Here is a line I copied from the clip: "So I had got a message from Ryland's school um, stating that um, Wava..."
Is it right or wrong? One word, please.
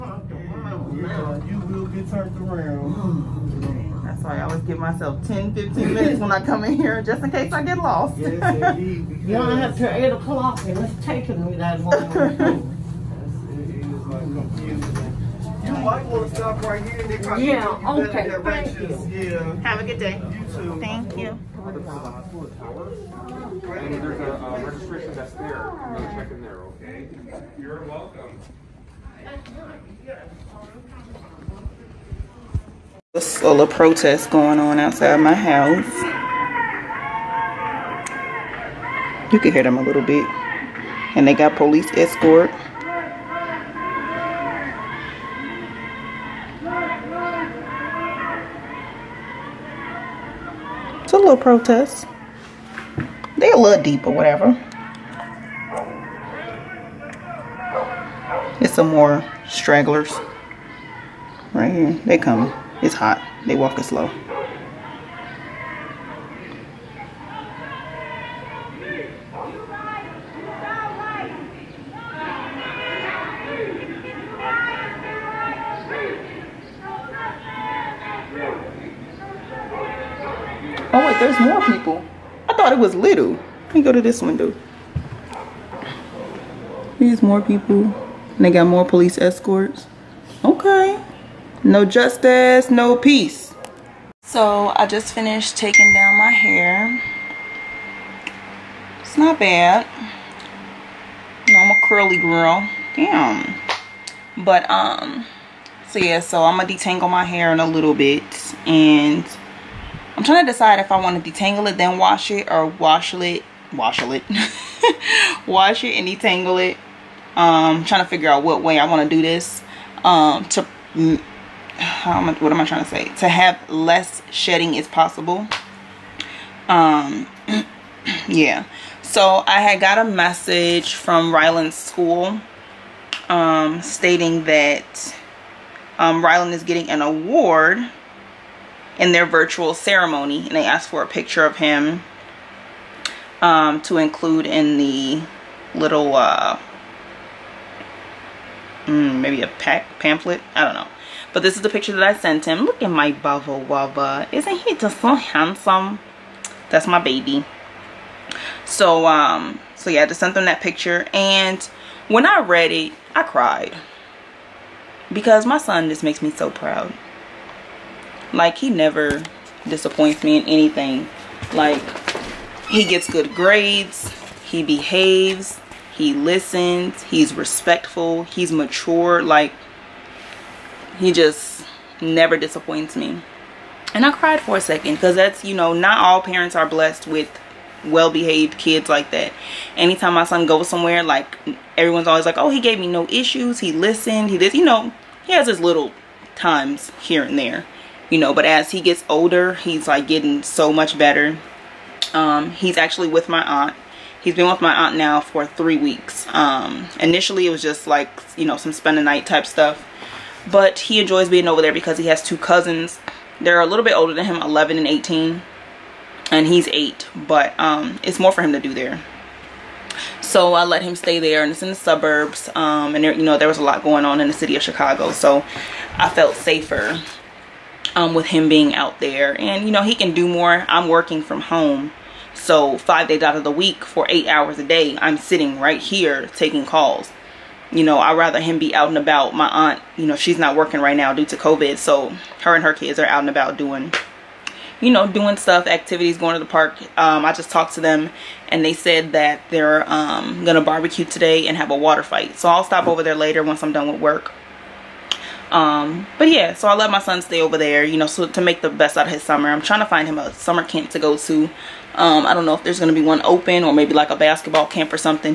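wrong.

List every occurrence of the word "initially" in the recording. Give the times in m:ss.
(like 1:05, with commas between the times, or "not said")
3:26.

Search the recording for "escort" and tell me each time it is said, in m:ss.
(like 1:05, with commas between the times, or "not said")
0:41, 1:29.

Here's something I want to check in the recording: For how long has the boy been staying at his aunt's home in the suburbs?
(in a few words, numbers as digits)
3 weeks.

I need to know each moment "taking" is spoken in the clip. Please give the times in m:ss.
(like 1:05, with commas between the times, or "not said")
0:11, 1:35, 3:56.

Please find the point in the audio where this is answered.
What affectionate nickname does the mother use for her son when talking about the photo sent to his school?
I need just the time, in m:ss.
2:33.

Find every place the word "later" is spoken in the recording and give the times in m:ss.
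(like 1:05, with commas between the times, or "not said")
4:13.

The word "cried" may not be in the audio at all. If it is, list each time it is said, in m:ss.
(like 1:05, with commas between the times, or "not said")
2:43, 3:04.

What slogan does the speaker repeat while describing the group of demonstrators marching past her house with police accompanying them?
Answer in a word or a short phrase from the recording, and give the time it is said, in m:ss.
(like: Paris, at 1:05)
No justice, no peace, at 1:31.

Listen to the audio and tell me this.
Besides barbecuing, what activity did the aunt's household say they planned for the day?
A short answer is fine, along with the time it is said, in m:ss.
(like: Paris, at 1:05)
Water fight, at 4:11.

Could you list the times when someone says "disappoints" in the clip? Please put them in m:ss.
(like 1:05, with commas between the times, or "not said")
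2:49, 3:02.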